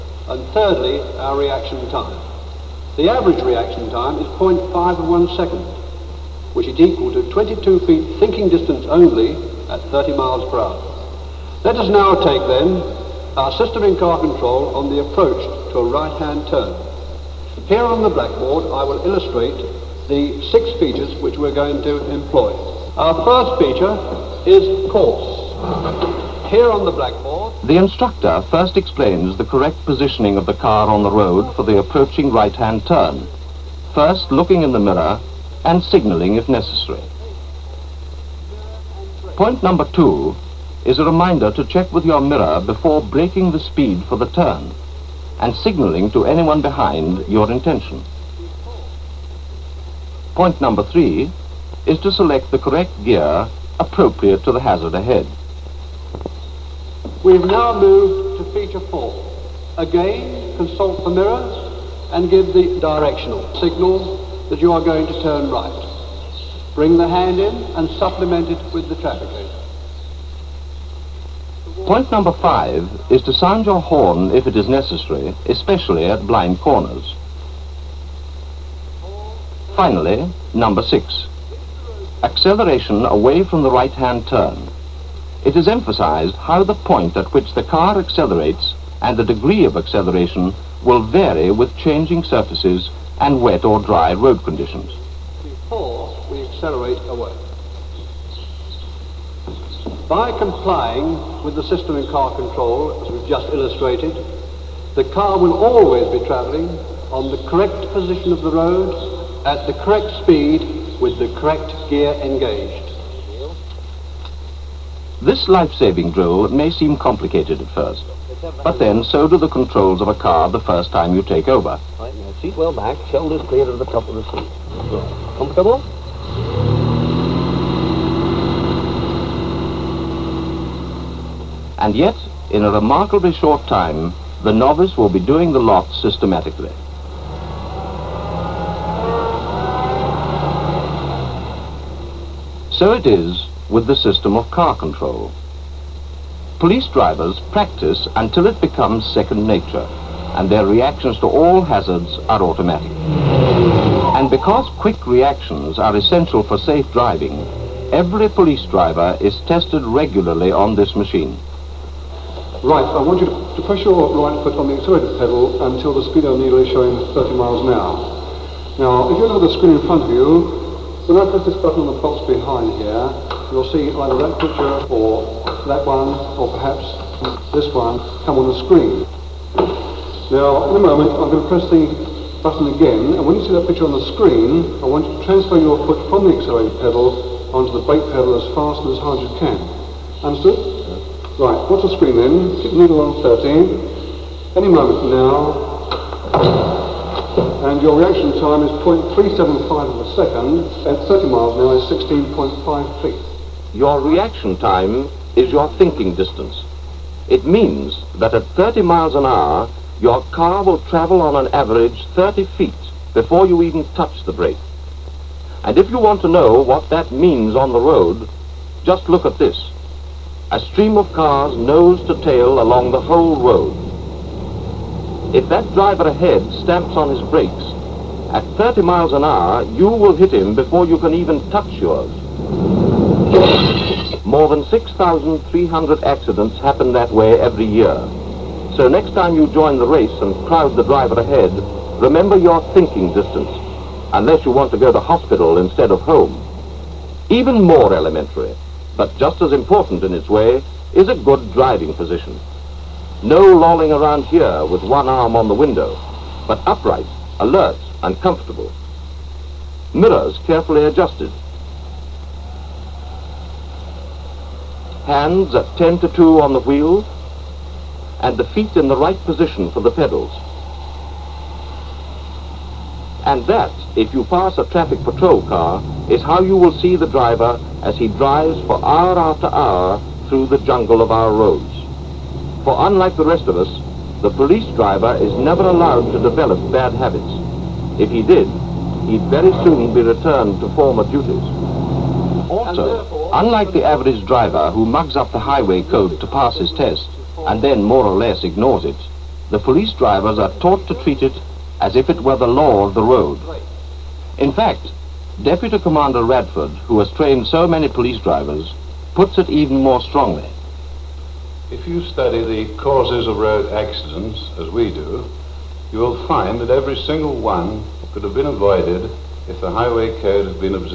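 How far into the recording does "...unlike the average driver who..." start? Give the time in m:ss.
4:53.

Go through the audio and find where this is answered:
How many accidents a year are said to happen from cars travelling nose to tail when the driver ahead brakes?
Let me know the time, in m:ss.
3:54.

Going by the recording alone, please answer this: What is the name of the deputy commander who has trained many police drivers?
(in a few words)
Radford.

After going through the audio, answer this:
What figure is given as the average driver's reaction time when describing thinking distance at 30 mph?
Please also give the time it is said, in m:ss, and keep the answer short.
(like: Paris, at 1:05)
0.5 of one second, at 0:04.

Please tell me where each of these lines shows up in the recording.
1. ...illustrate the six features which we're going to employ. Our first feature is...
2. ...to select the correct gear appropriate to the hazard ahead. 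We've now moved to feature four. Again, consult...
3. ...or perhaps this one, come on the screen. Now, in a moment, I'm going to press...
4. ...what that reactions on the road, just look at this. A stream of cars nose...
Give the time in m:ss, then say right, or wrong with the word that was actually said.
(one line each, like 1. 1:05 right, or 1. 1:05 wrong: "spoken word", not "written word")
1. 0:19 right
2. 0:51 right
3. 2:56 right
4. 3:36 wrong: "means", not "reactions".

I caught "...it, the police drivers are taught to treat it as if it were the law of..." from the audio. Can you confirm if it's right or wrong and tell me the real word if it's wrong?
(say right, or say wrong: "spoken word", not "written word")
right.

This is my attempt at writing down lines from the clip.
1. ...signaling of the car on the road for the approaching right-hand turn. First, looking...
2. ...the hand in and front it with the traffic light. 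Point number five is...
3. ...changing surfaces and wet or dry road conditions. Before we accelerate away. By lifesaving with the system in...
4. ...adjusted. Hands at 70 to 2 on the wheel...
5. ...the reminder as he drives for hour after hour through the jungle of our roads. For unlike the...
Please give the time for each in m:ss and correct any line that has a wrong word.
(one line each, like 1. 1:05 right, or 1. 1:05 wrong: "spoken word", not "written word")
1. 0:29 wrong: "positioning", not "signaling"
2. 1:06 wrong: "supplement", not "front"
3. 1:31 wrong: "complying", not "lifesaving"
4. 4:20 wrong: "10", not "70"
5. 4:36 wrong: "driver", not "reminder".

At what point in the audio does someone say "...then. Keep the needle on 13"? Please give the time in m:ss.
3:12.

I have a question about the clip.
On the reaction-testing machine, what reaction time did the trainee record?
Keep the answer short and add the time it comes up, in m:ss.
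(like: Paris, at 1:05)
0.375 of a second, at 3:18.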